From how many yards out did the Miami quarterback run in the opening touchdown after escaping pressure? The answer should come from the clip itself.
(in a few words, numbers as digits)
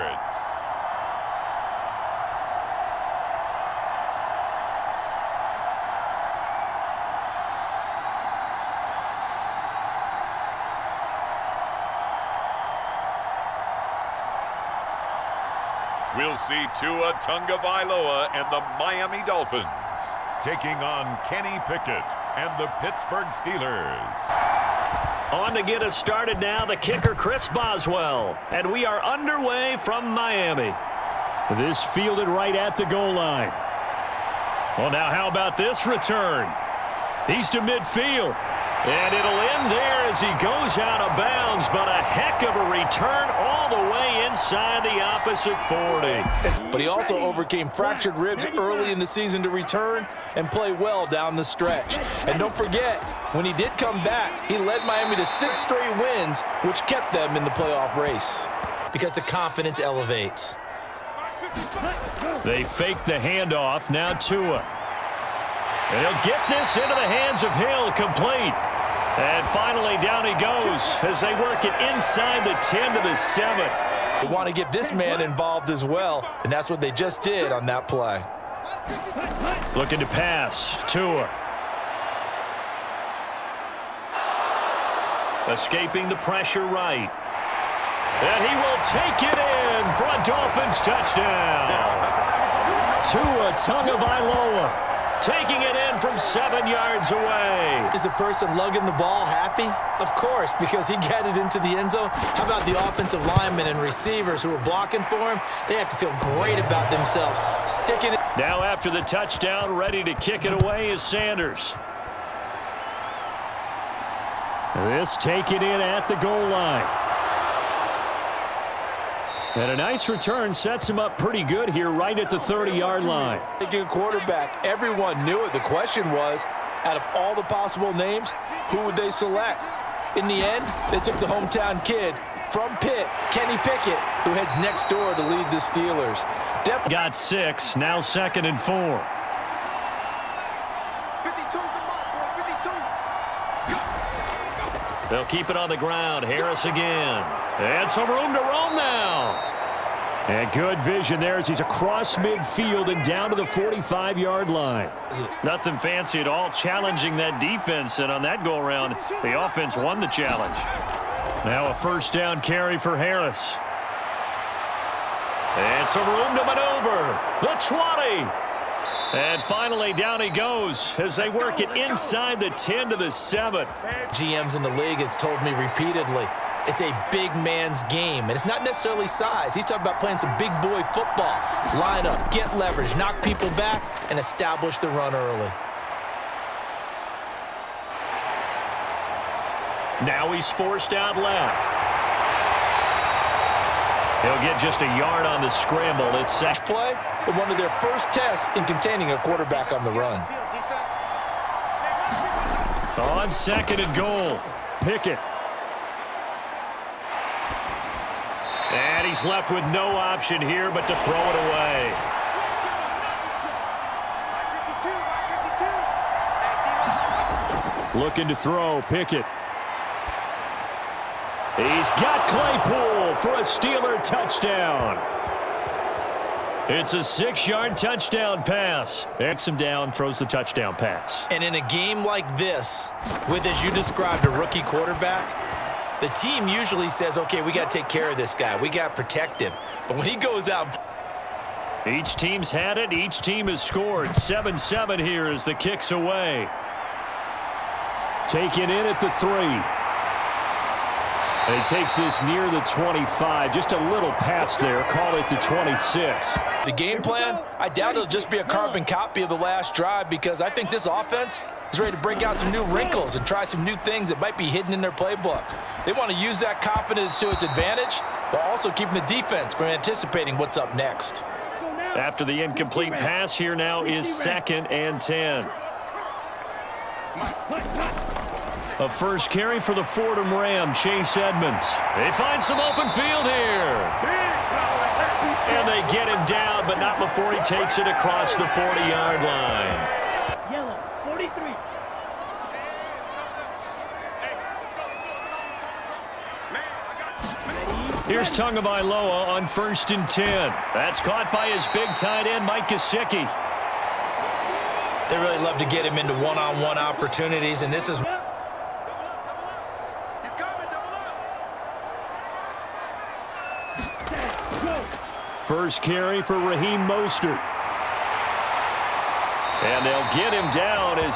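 7.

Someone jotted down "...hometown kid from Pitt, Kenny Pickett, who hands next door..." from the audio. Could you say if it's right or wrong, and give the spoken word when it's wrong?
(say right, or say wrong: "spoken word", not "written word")
wrong: "heads", not "hands".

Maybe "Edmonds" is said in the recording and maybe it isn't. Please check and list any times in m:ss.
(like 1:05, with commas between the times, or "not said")
4:41.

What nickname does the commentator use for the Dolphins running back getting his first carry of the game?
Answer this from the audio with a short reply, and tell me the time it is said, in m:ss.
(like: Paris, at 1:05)
Fordham Ram, at 4:39.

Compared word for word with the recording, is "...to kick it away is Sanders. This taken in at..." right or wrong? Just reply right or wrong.
right.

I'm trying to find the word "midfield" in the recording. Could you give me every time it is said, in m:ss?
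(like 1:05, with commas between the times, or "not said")
0:37, 2:32.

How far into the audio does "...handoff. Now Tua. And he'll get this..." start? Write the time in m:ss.
1:03.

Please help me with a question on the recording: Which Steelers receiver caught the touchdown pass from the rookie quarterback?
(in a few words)
Claypool.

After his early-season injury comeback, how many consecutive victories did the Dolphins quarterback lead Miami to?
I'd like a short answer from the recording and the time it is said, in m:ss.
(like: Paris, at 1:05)
6, at 0:55.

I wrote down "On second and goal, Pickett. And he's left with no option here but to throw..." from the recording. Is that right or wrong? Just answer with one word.
right.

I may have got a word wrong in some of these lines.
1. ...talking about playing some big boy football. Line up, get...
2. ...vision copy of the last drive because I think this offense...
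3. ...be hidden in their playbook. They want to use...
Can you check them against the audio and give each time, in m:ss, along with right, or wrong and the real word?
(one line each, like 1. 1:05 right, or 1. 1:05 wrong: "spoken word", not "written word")
1. 2:59 right
2. 4:18 wrong: "carbon", not "vision"
3. 4:24 right.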